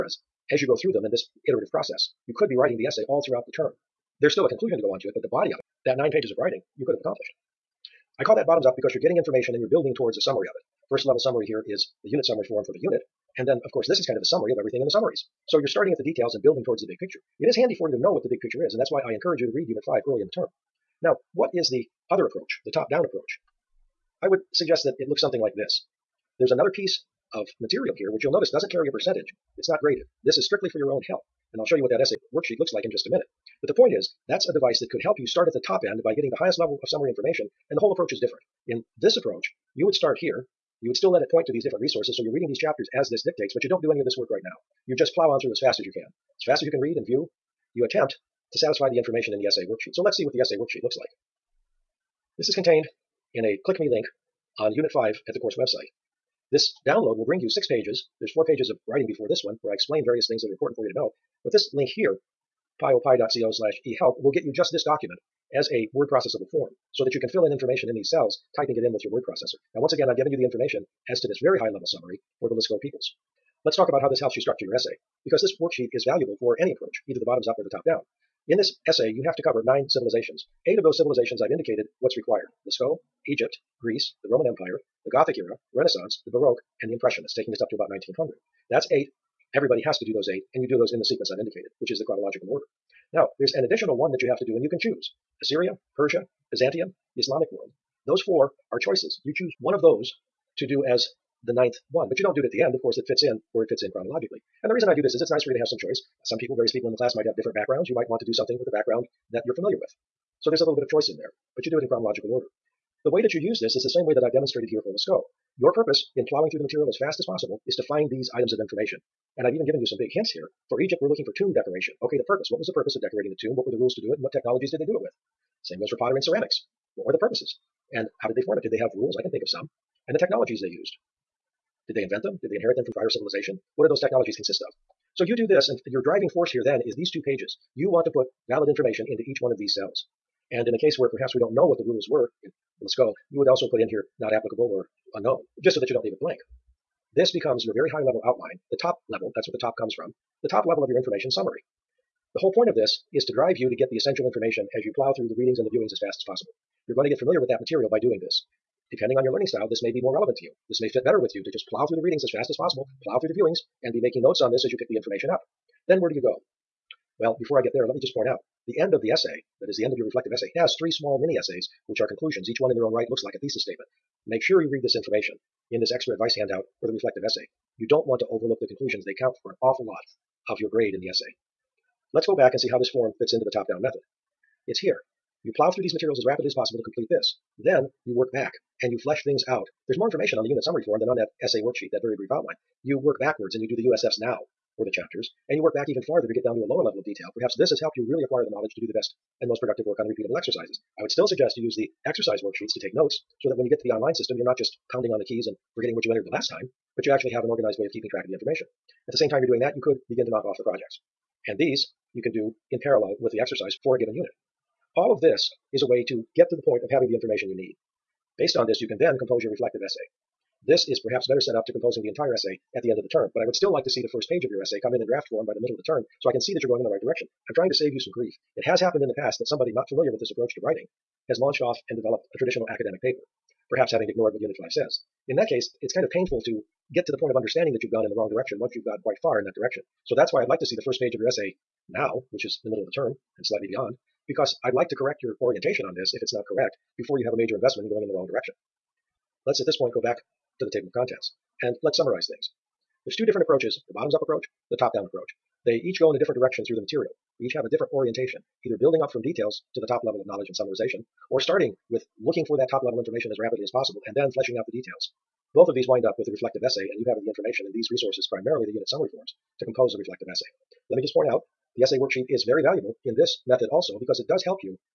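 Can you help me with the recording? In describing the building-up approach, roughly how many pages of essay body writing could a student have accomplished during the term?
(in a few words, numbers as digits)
9.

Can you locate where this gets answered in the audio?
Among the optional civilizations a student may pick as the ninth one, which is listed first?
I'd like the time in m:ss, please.
1:35.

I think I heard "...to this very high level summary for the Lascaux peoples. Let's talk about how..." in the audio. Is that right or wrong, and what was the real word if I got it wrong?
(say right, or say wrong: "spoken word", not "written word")
right.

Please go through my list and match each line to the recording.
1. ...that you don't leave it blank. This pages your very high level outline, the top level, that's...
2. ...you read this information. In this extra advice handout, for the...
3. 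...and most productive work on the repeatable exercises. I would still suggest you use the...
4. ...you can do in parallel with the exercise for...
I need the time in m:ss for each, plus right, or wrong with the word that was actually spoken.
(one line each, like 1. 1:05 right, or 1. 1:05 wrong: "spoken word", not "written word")
1. 2:25 wrong: "becomes", not "pages"
2. 2:54 right
3. 3:19 right
4. 3:32 right.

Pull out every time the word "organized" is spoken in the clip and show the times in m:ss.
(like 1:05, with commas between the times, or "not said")
3:27.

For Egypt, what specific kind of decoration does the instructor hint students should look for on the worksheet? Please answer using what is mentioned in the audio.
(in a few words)
Tomb decoration.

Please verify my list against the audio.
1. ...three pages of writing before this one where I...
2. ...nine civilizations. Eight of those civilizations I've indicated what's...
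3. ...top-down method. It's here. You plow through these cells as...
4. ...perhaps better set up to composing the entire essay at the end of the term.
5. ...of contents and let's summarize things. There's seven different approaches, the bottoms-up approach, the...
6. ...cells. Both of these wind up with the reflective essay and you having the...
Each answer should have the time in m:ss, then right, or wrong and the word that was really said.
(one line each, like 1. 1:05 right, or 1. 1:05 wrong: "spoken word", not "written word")
1. 0:58 wrong: "four", not "three"
2. 1:19 right
3. 3:03 wrong: "materials", not "cells"
4. 3:41 right
5. 4:10 wrong: "two", not "seven"
6. 4:24 wrong: "details", not "cells".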